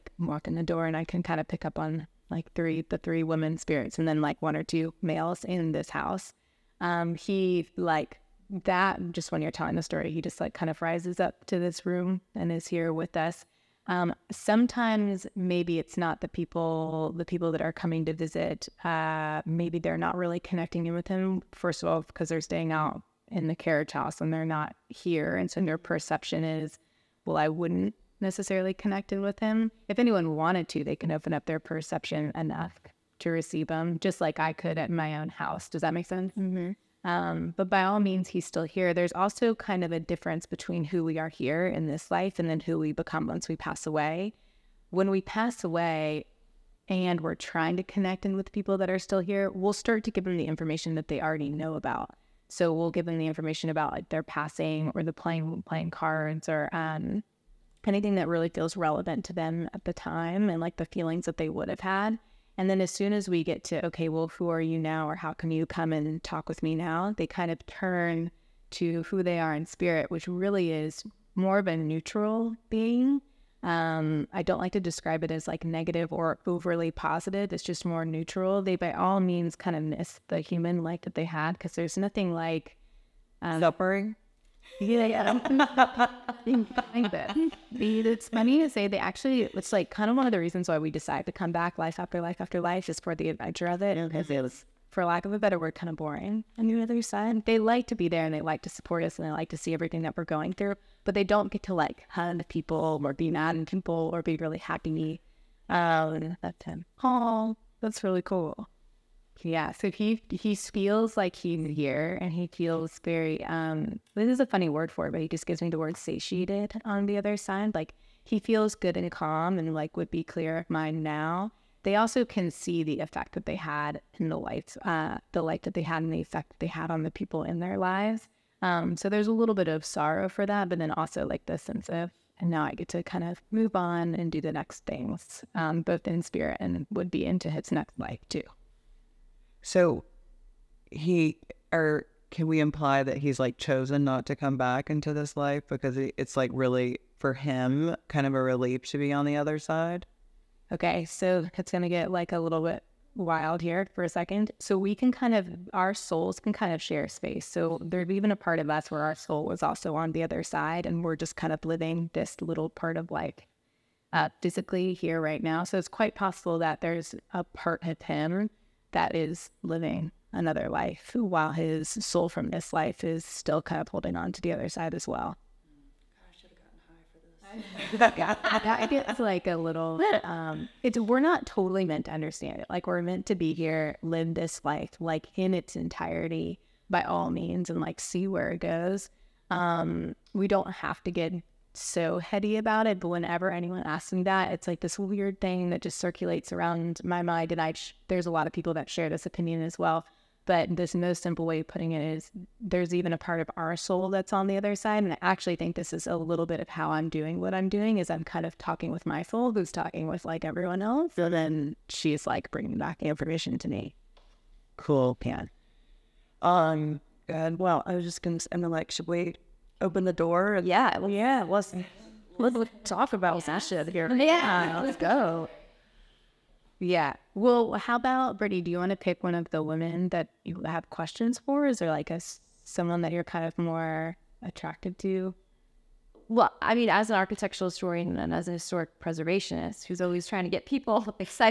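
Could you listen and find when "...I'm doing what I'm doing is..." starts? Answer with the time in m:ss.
3:26.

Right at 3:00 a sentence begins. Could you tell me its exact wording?
Um, it's we're not totally meant to understand it.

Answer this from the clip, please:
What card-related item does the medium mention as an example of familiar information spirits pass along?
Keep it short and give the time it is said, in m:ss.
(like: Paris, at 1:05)
Playing cards, at 0:55.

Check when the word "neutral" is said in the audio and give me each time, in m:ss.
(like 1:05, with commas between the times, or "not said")
1:11, 1:18.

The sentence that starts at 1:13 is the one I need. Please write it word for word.
Um, I don't like to describe it as like negative or overly positive.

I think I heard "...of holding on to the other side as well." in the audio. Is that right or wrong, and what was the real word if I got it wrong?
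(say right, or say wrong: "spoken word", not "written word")
right.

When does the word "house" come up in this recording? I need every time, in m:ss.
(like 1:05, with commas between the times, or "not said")
0:05, 0:23, 0:35.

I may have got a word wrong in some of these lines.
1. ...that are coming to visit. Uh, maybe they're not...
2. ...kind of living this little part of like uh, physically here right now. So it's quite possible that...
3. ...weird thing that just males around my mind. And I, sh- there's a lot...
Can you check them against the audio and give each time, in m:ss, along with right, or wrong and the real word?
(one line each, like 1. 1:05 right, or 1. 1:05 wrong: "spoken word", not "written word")
1. 0:17 right
2. 2:41 right
3. 3:14 wrong: "circulates", not "males".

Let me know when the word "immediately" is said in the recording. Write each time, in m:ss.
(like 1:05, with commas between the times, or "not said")
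not said.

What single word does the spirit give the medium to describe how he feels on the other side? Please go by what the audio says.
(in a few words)
Satiated.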